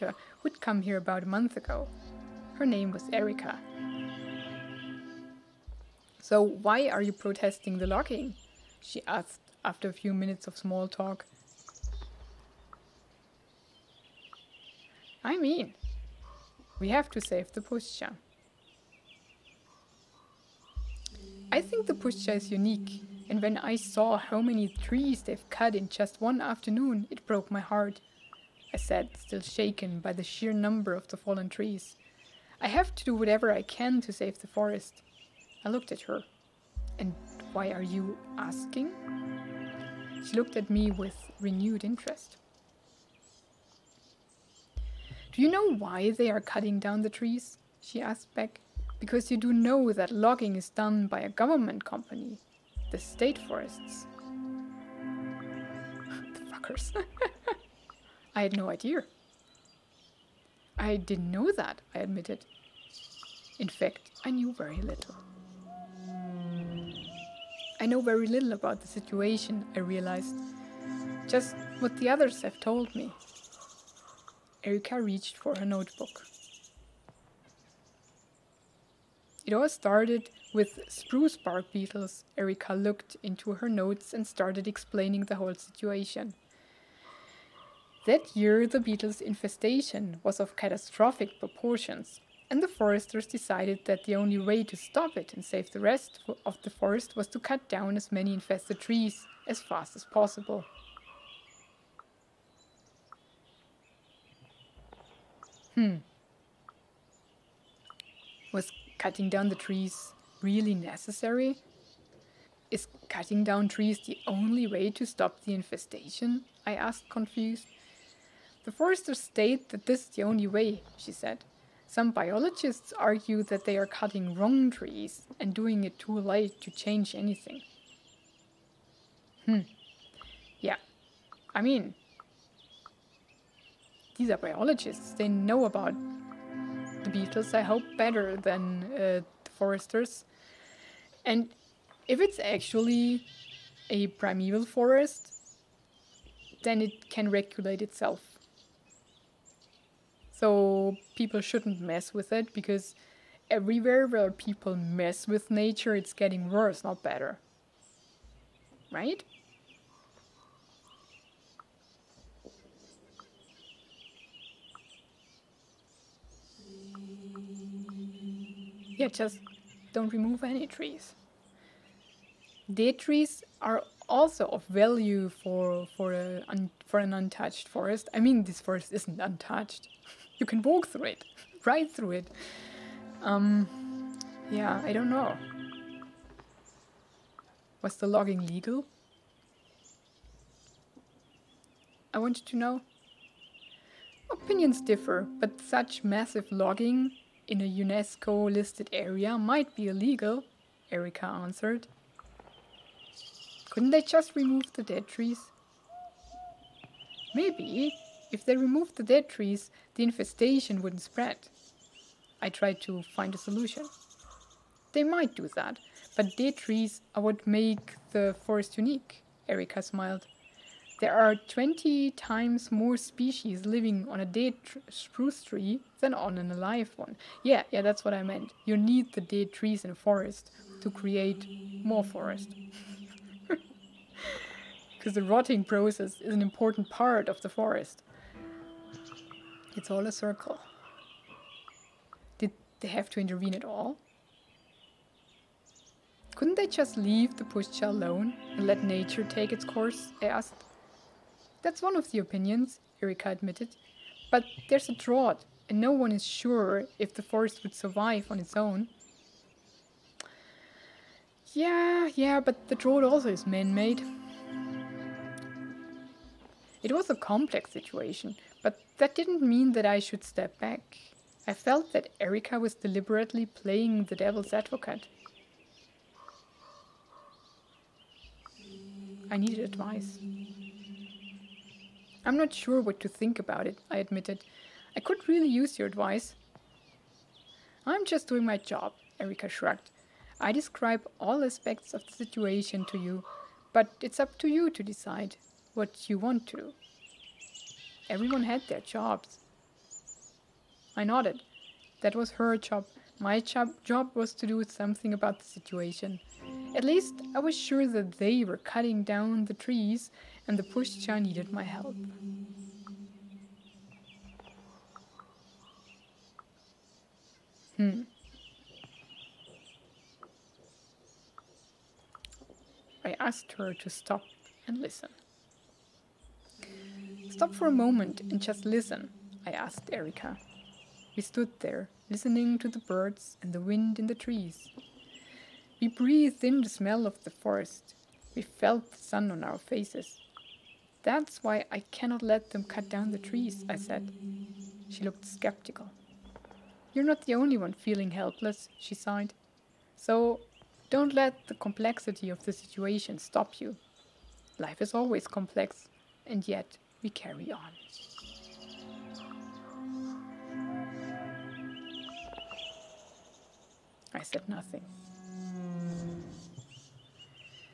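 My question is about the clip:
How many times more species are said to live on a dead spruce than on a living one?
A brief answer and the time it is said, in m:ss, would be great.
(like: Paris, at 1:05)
20, at 3:41.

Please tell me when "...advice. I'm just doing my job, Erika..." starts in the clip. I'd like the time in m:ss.
4:45.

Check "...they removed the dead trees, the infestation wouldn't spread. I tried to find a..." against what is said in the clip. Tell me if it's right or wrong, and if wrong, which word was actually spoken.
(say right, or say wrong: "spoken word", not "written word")
right.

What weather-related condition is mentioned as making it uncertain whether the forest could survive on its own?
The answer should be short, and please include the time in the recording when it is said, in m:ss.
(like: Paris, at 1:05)
a drought, at 4:14.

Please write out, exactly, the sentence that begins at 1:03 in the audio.
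In fact, I knew very little.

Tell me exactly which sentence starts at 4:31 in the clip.
I felt that Erika was deliberately playing the devil's advocate.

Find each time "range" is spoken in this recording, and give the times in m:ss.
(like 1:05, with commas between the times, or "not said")
not said.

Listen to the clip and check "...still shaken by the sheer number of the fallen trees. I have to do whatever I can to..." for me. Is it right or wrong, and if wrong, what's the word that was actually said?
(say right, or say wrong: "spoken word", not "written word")
right.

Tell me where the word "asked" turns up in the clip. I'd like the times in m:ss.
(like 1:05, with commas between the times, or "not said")
0:09, 0:48, 1:56, 4:10, 5:23, 5:29.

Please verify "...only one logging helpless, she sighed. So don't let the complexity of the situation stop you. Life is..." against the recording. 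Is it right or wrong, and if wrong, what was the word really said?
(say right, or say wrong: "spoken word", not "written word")
wrong: "feeling", not "logging".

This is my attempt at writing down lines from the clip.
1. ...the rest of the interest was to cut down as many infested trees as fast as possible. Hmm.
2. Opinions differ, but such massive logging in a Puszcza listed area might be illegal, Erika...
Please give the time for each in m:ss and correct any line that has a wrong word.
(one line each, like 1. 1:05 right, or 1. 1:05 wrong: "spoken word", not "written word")
1. 1:35 wrong: "forest", not "interest"
2. 3:14 wrong: "UNESCO", not "Puszcza".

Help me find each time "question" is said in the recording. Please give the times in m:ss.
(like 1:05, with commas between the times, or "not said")
not said.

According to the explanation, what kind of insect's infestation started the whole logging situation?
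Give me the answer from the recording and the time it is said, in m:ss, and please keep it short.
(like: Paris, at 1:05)
spruce bark beetles, at 1:20.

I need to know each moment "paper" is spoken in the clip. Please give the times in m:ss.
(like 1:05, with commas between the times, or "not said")
not said.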